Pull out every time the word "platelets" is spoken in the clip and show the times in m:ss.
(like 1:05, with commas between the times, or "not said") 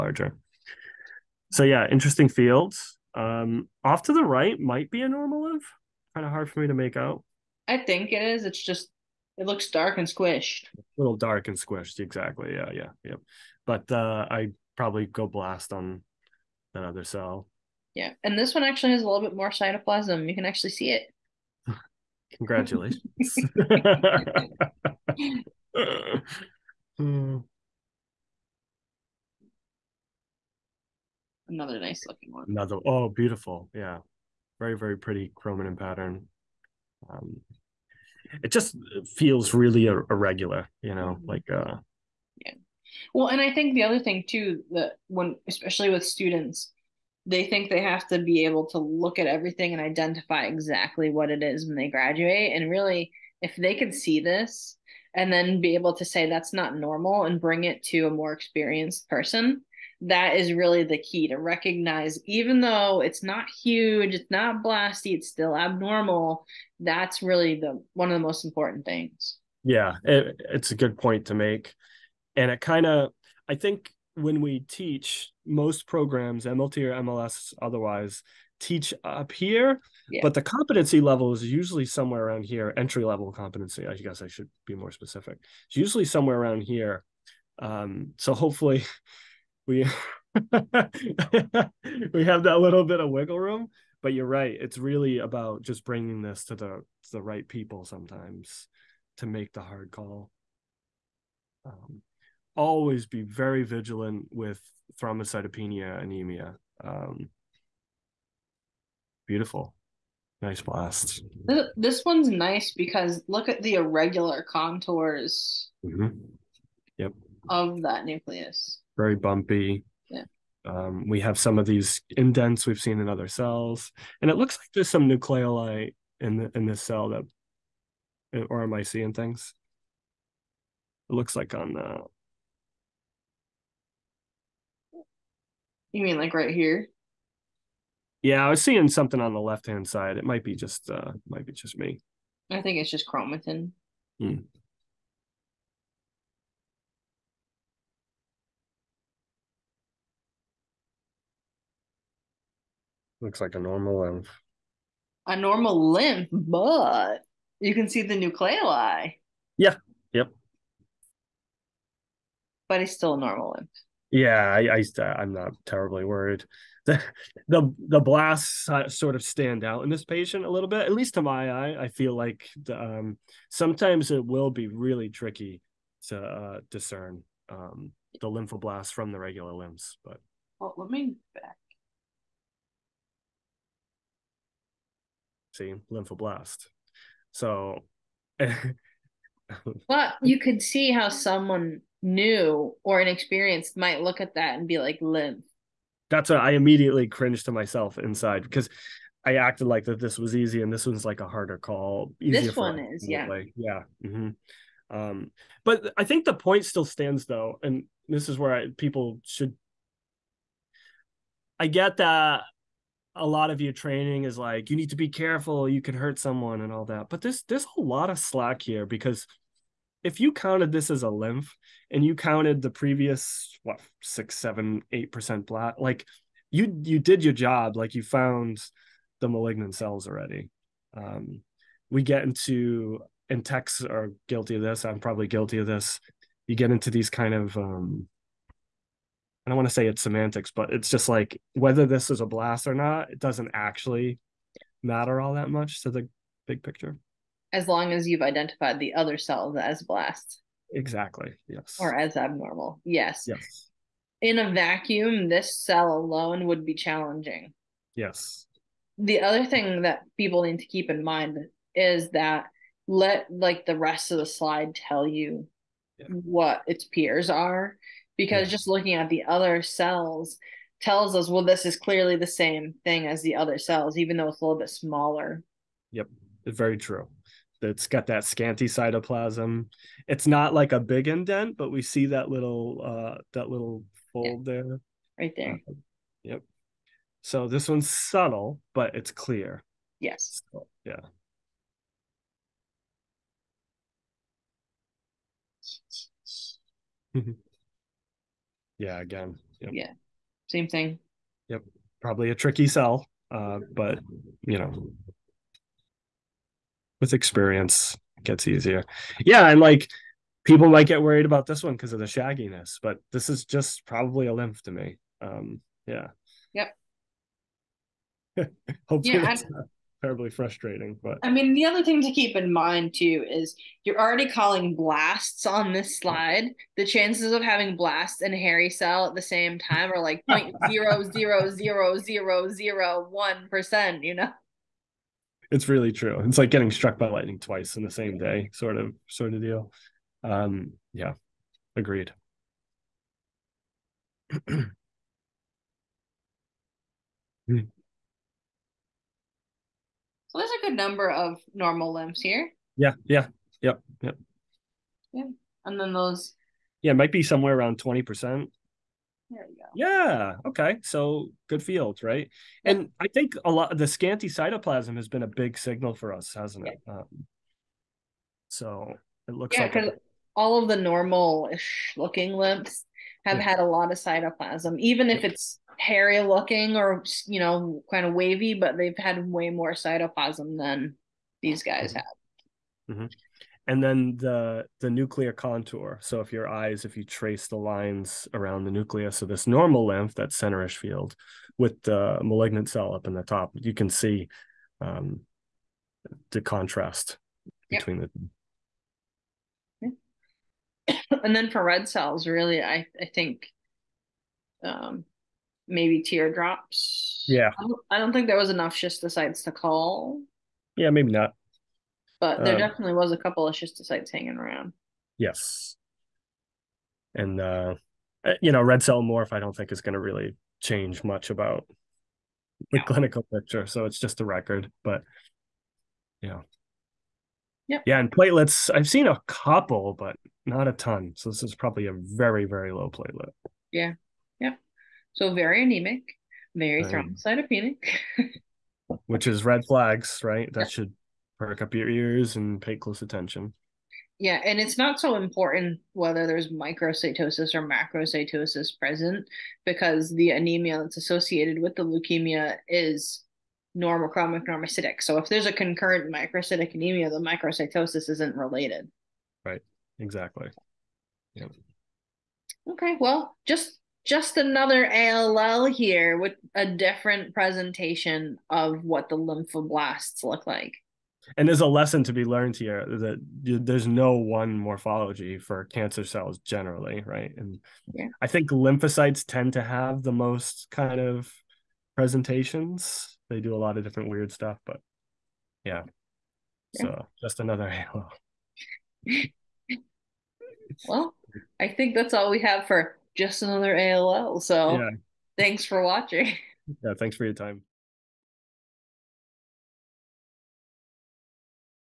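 7:08, 7:12.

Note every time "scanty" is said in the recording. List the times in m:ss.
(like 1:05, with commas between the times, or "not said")
4:38, 6:03.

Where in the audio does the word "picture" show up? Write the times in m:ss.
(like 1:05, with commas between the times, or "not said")
4:06, 7:03.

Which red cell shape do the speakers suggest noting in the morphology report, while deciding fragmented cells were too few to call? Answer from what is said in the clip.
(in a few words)
teardrops.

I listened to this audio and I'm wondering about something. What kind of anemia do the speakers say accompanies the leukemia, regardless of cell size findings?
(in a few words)
normochromic normocytic.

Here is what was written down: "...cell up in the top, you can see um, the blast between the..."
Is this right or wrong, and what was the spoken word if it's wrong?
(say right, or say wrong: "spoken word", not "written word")
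wrong: "contrast", not "blast".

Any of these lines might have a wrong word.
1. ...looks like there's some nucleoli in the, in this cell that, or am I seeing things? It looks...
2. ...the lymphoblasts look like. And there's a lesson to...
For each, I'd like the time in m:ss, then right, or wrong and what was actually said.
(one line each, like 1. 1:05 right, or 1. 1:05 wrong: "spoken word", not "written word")
1. 2:04 right
2. 7:49 right.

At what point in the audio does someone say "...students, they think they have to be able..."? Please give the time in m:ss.
0:46.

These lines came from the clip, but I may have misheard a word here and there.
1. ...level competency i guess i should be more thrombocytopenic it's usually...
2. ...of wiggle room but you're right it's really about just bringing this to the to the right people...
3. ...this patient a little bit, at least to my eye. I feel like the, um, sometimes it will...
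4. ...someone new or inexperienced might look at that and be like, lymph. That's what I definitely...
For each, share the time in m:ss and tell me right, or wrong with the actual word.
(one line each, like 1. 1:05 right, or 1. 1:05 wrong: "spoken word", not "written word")
1. 1:23 wrong: "specific", not "thrombocytopenic"
2. 1:32 right
3. 2:49 right
4. 3:11 wrong: "immediately", not "definitely".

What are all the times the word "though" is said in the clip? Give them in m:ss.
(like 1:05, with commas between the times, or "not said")
1:02, 3:27, 4:34.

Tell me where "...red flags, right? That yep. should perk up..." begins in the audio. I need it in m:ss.
7:19.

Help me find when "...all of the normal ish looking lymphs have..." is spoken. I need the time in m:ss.
6:10.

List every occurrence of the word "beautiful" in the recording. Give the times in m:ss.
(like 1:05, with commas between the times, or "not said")
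0:33, 1:49.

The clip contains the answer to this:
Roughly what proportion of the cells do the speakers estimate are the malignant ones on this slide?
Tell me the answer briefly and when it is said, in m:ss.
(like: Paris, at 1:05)
20%, at 5:57.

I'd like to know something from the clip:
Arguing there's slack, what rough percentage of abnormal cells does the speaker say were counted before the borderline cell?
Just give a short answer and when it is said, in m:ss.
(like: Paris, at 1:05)
6-8%, at 3:44.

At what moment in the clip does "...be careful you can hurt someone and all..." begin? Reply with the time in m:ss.
3:34.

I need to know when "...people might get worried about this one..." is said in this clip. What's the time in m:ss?
5:10.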